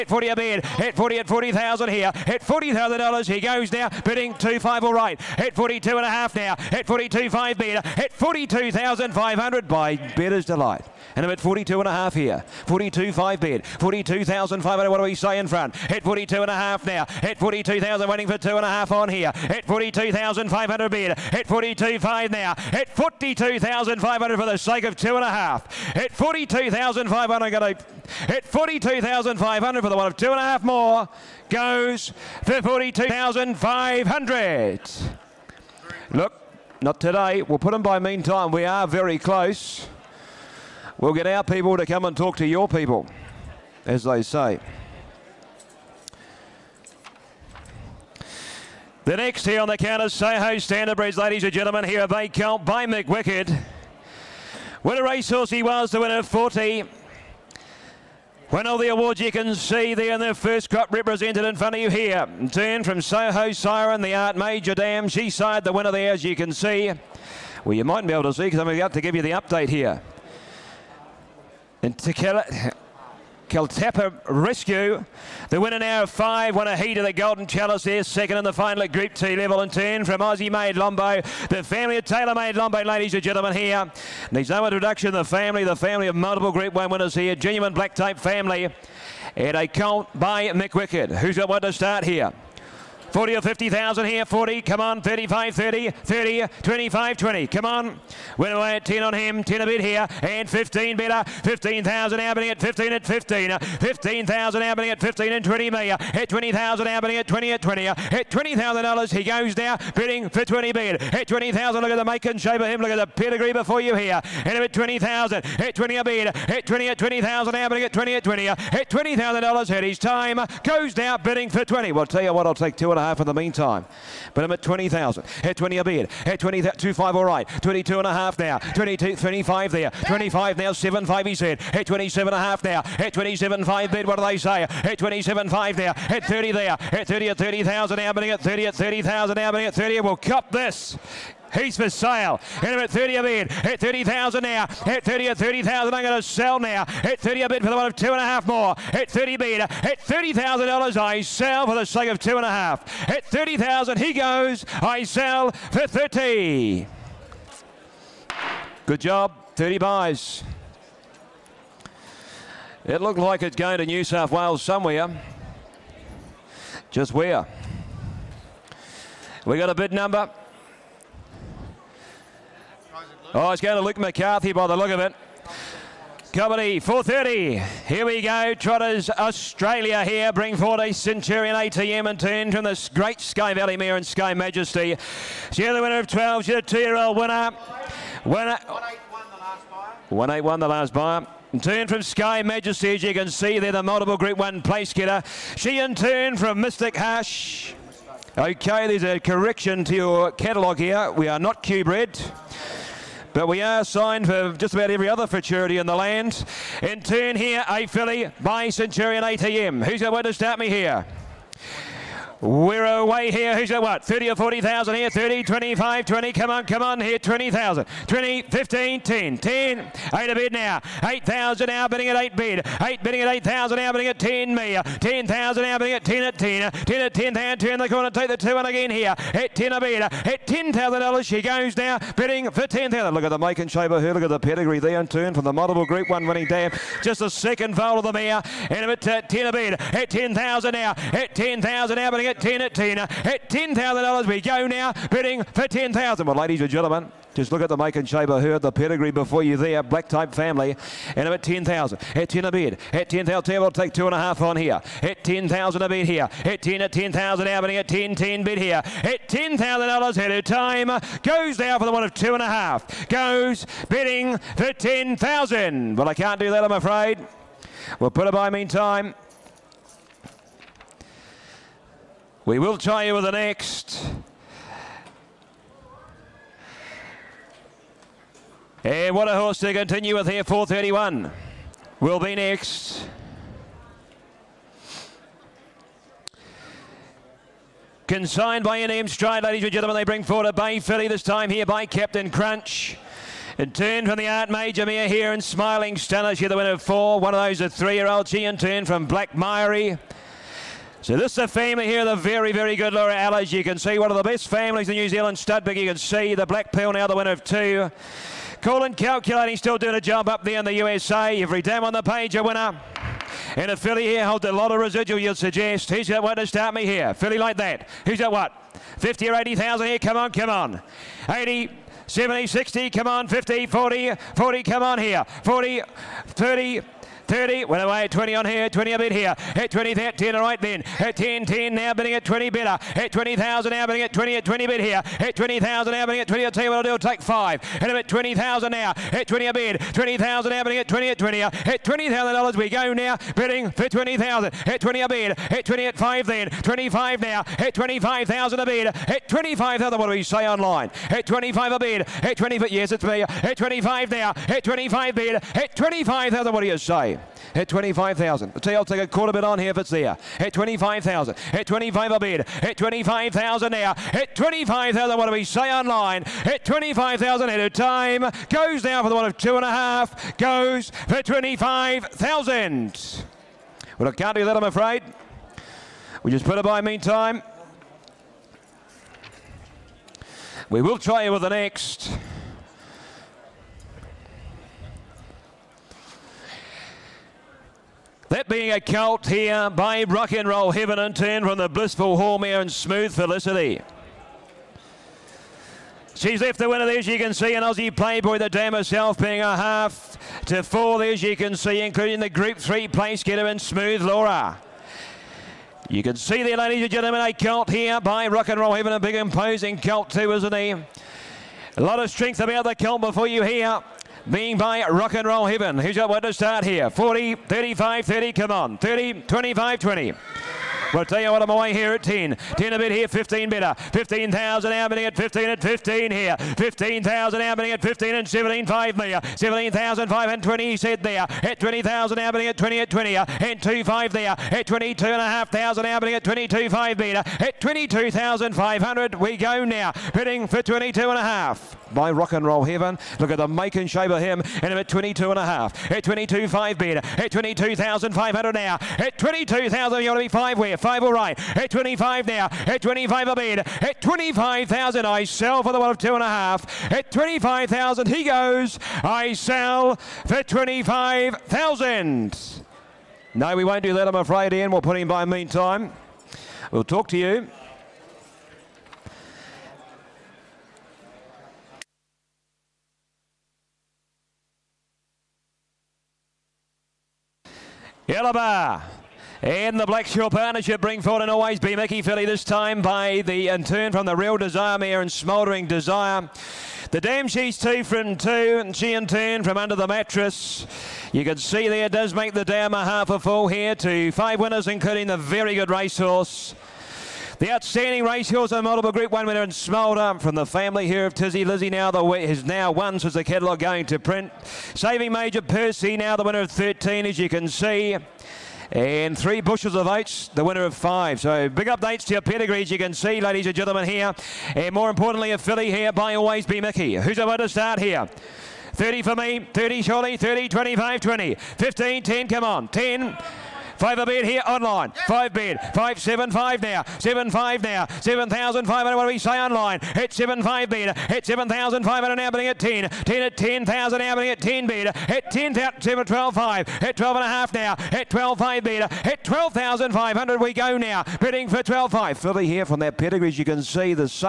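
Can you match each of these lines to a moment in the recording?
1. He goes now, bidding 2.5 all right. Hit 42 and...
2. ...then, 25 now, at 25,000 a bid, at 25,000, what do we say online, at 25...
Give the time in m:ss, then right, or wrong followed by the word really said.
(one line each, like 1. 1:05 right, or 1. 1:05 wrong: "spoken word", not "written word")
1. 0:03 right
2. 5:46 right.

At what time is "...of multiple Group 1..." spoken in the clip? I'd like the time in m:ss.
1:26.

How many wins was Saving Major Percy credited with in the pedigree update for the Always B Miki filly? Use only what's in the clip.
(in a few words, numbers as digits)
13.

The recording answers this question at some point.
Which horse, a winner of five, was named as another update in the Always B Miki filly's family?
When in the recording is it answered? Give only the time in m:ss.
8:29.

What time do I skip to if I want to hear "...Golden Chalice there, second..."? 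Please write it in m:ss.
1:17.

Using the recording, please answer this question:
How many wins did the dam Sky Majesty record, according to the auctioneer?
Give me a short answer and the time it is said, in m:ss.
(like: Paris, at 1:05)
12, at 3:05.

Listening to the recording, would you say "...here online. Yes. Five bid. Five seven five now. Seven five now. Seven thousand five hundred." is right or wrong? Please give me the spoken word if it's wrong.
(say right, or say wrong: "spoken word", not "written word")
right.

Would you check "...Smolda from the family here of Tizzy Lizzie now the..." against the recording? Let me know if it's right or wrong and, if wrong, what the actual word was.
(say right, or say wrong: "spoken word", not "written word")
right.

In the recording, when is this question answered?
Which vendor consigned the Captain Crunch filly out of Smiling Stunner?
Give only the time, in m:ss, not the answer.
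4:48.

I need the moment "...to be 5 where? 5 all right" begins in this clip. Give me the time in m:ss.
7:30.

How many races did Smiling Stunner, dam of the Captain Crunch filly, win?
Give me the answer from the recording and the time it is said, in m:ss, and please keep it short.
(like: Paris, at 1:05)
4, at 4:56.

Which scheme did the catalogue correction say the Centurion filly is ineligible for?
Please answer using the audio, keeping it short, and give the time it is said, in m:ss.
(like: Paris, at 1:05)
Q-bred, at 3:21.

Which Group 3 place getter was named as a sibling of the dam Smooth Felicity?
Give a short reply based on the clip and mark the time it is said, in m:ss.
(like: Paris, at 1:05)
Smooth Laura, at 6:43.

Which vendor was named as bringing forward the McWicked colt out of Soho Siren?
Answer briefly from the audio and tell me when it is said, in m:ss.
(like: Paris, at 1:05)
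Soho Standardbreds, at 0:50.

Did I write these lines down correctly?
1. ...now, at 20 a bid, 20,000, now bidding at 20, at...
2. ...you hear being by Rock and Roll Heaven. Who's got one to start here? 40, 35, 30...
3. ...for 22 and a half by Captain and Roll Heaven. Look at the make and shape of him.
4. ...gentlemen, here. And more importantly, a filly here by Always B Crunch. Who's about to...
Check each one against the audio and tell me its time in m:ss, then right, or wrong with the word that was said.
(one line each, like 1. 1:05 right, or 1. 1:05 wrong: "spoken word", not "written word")
1. 5:38 right
2. 6:53 right
3. 7:20 wrong: "Rock", not "Captain"
4. 8:33 wrong: "Miki", not "Crunch".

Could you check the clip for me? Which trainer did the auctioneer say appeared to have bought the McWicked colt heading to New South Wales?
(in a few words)
Luke McCarthy.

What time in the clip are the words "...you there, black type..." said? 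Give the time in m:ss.
4:09.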